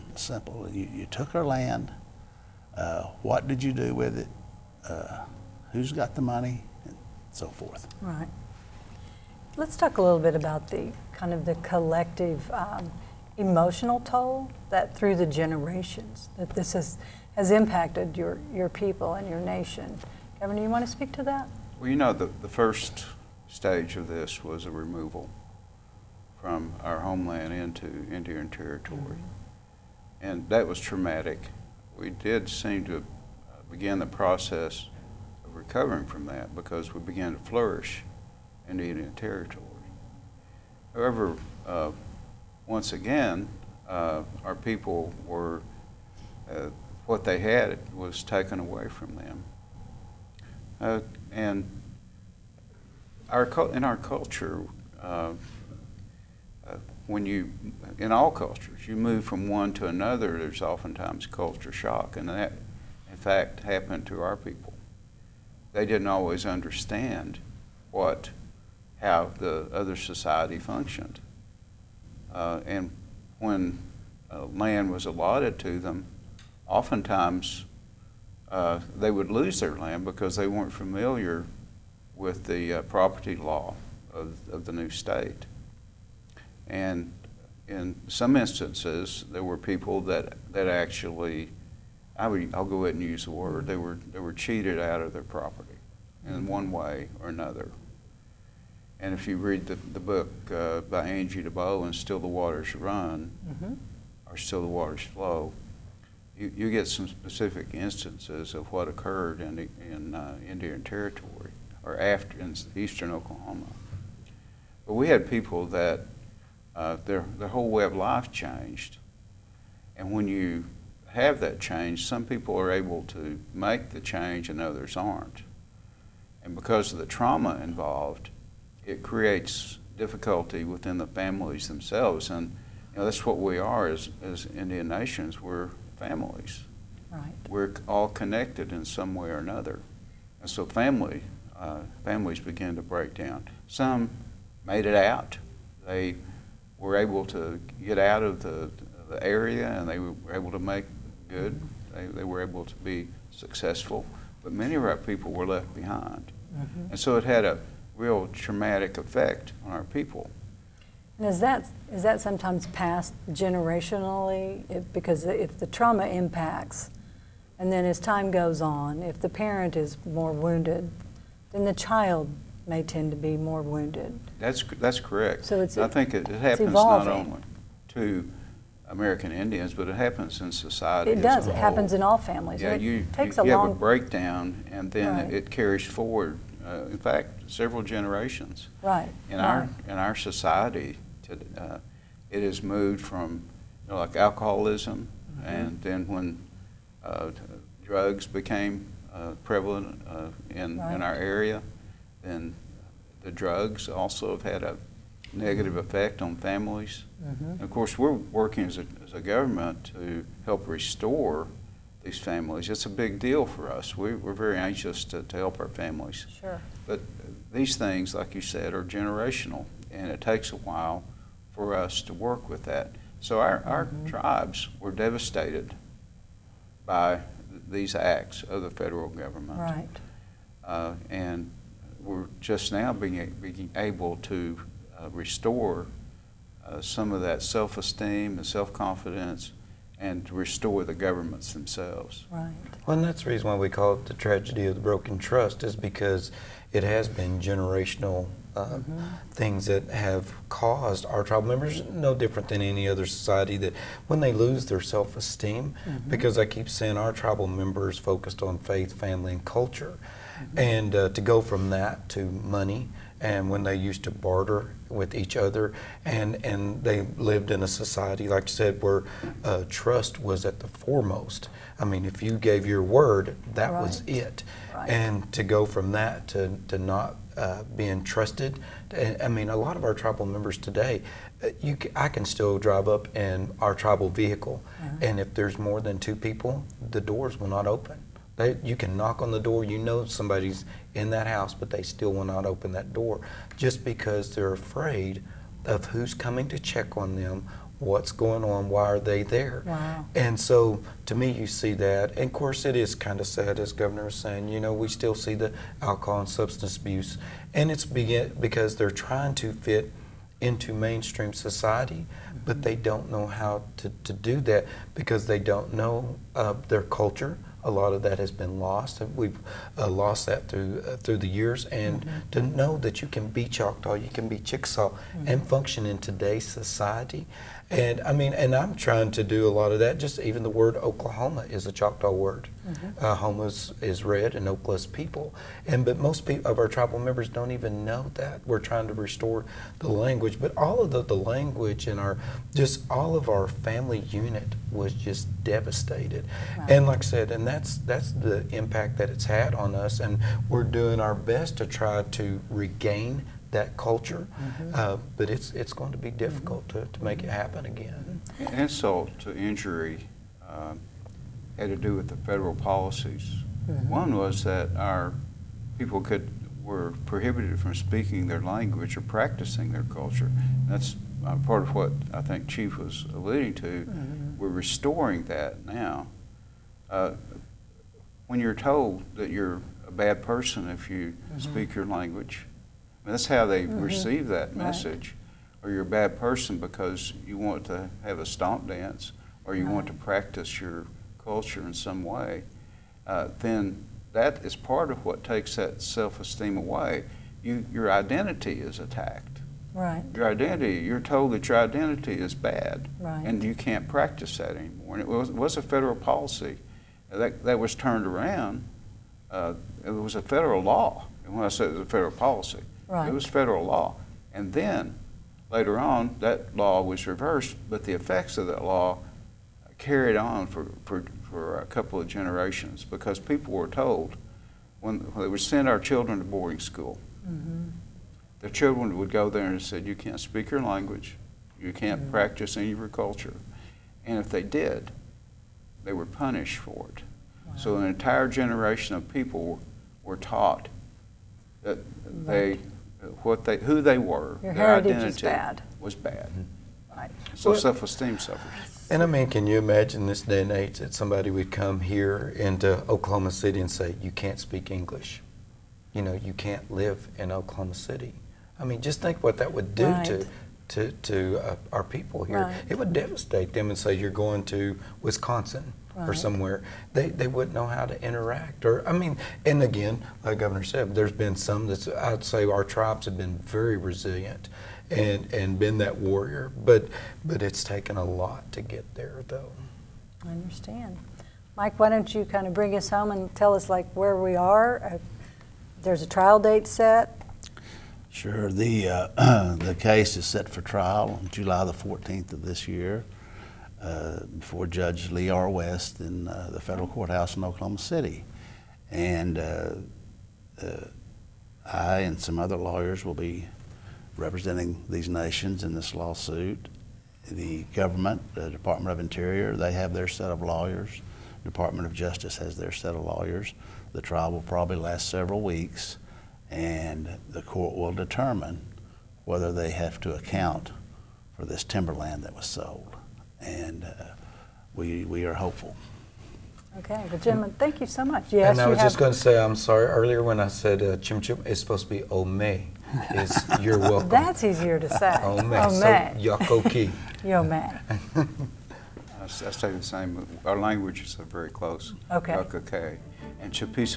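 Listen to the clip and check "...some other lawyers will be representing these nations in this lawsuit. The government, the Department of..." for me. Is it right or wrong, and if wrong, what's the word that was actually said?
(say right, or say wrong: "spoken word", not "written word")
right.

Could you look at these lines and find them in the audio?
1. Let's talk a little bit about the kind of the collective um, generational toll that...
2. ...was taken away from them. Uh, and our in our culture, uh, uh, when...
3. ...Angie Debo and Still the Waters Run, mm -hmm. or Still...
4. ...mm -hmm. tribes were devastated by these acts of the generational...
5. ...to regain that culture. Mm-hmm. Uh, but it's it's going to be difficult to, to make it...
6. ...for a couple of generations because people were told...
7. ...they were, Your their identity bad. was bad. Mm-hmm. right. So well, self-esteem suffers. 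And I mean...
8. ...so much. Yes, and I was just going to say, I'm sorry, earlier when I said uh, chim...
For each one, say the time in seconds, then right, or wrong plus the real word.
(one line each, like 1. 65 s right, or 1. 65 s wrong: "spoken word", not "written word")
1. 9 s wrong: "emotional", not "generational"
2. 47 s right
3. 101 s right
4. 223 s wrong: "federal", not "generational"
5. 352 s right
6. 421 s right
7. 443 s right
8. 527 s right.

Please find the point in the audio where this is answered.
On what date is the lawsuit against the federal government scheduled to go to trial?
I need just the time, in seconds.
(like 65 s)
491 s.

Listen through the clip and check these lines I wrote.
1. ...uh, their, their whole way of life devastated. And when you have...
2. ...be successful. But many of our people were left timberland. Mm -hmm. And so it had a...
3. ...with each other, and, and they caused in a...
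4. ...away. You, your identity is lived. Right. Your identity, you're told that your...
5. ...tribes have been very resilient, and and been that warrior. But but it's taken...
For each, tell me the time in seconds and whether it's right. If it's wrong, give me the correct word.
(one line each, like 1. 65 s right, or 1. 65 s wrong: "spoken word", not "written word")
1. 116 s wrong: "changed", not "devastated"
2. 152 s wrong: "behind", not "timberland"
3. 264 s wrong: "lived", not "caused"
4. 396 s wrong: "attacked", not "lived"
5. 472 s right.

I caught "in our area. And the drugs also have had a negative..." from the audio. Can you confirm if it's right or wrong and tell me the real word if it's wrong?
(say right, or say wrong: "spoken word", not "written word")
right.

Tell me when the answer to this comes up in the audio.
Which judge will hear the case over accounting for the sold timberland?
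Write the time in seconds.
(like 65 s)
495 s.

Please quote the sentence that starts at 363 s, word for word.
One was that our people could were prohibited from speaking their language or practicing their culture.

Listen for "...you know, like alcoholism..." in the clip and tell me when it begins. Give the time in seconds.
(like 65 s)
193 s.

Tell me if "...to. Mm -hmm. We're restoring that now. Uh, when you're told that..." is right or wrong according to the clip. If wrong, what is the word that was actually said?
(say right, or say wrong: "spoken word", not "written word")
right.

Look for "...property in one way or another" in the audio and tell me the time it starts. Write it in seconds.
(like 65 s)
95 s.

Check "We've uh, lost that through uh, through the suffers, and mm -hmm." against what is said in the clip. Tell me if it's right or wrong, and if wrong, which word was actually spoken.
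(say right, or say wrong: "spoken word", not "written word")
wrong: "years", not "suffers".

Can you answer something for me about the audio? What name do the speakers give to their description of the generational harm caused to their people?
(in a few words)
The tragedy of the broken trust.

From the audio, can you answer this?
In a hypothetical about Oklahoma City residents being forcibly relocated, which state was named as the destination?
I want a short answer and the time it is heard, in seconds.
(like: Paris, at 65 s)
Wisconsin, at 465 s.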